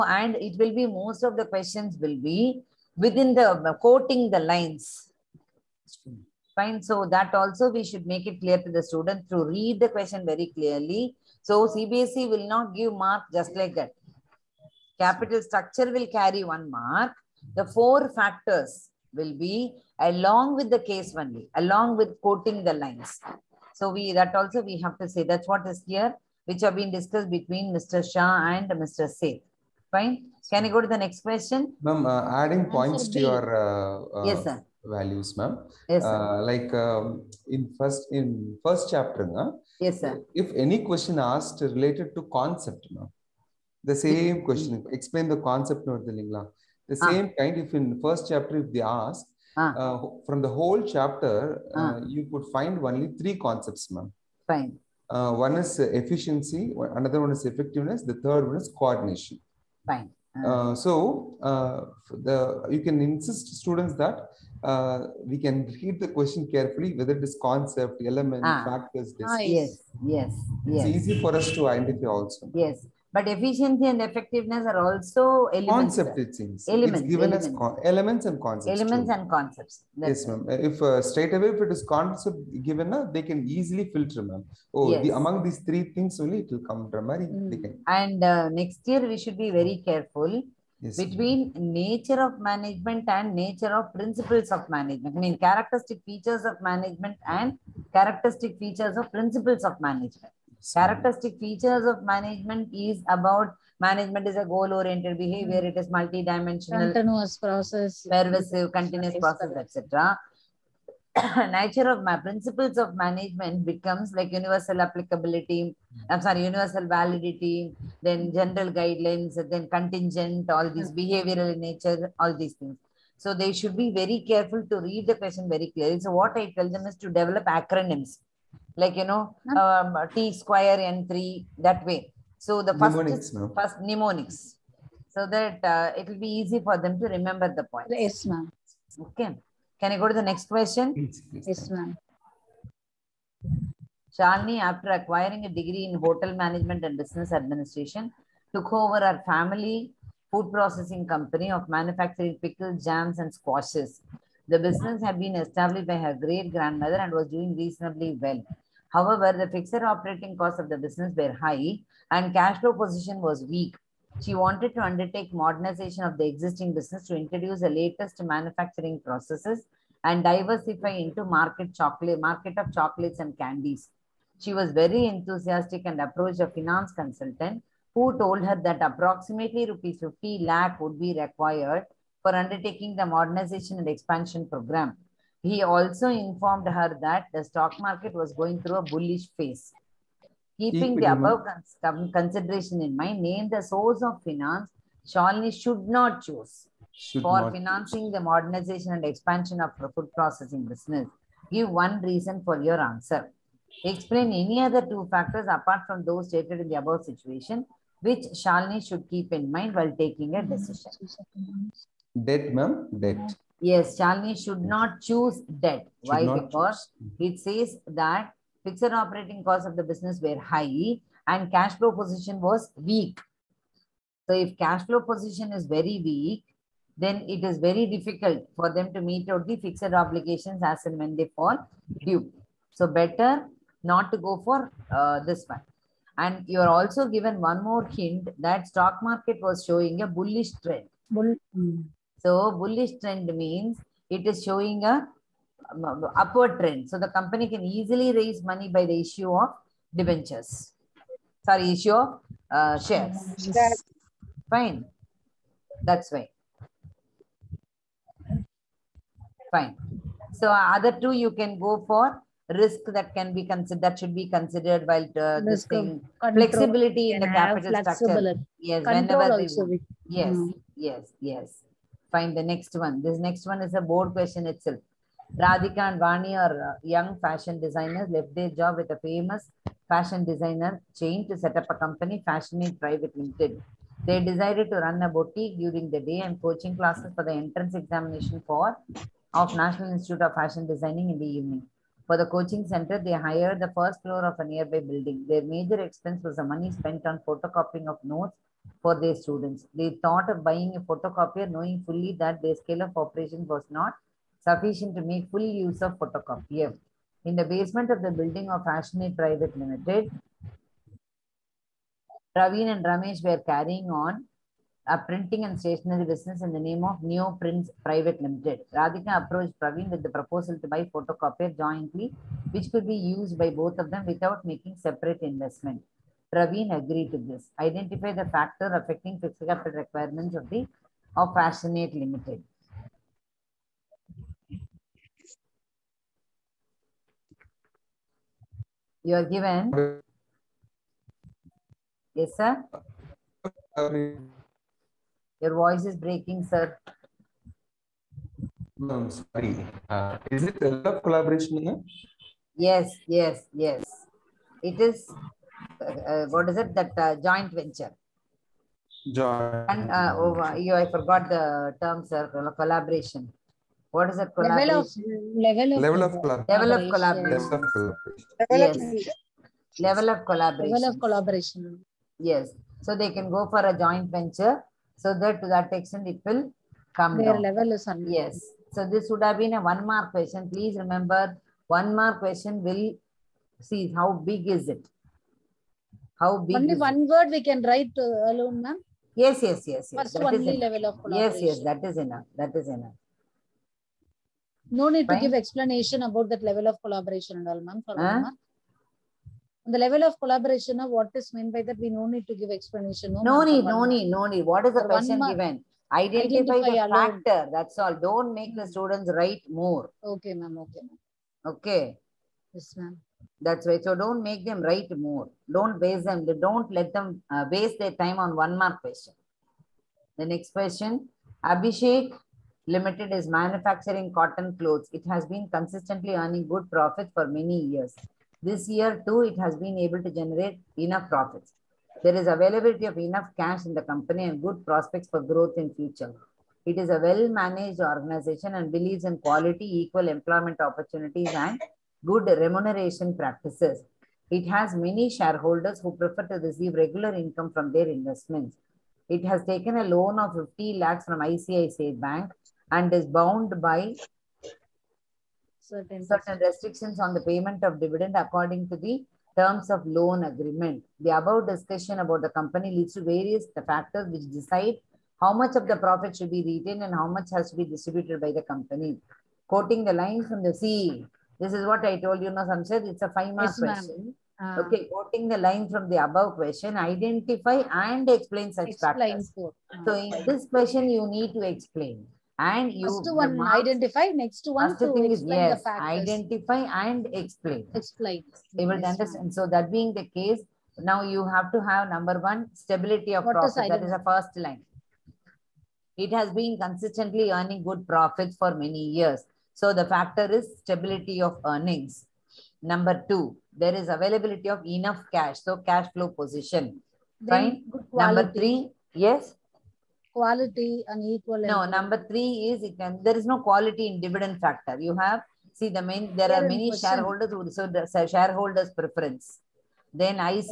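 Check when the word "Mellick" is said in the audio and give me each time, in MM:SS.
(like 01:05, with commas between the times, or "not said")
not said.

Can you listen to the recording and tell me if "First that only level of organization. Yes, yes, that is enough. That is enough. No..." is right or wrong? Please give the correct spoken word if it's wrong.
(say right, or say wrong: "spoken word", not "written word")
wrong: "collaboration", not "organization".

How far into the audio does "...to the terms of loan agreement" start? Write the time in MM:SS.
07:38.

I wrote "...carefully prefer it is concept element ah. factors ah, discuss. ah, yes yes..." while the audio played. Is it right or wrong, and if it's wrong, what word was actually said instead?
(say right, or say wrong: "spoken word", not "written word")
wrong: "whether", not "prefer".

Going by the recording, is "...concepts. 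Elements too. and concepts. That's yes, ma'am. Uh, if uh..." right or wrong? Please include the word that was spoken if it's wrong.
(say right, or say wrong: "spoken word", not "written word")
right.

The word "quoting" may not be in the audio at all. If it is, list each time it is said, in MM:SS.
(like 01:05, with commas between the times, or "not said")
00:03, 00:22, 07:49, 07:54.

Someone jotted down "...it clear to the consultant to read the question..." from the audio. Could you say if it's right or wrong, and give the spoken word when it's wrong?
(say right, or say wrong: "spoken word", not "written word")
wrong: "student", not "consultant".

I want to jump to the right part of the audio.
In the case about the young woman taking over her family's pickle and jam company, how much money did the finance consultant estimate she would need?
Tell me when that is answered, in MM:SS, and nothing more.
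02:59.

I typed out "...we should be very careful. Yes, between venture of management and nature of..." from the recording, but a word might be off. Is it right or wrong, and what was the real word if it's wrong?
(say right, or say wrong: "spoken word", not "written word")
wrong: "nature", not "venture".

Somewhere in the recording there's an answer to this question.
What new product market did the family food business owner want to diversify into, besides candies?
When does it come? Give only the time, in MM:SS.
02:52.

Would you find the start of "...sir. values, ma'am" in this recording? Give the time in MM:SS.
00:34.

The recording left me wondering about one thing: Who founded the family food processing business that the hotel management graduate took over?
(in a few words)
Her great grandmother.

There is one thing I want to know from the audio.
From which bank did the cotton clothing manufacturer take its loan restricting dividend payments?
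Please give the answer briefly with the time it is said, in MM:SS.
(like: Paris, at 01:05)
ICICI Bank, at 07:31.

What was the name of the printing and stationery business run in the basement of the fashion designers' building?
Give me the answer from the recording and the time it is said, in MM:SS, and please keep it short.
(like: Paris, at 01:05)
Neo Prints Private Limited, at 05:17.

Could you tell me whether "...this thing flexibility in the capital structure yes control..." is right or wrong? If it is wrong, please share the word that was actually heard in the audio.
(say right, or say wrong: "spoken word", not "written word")
right.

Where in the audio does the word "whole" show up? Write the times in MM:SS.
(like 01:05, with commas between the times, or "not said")
00:50.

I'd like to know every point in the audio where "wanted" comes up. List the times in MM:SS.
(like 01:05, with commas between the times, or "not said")
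02:44.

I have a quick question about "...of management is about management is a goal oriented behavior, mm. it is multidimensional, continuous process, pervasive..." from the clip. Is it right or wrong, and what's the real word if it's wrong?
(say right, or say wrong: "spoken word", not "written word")
right.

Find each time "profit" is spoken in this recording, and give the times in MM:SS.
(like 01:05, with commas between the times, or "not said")
07:06, 07:11, 07:45, 08:13, 08:17.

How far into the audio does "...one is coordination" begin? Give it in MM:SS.
00:58.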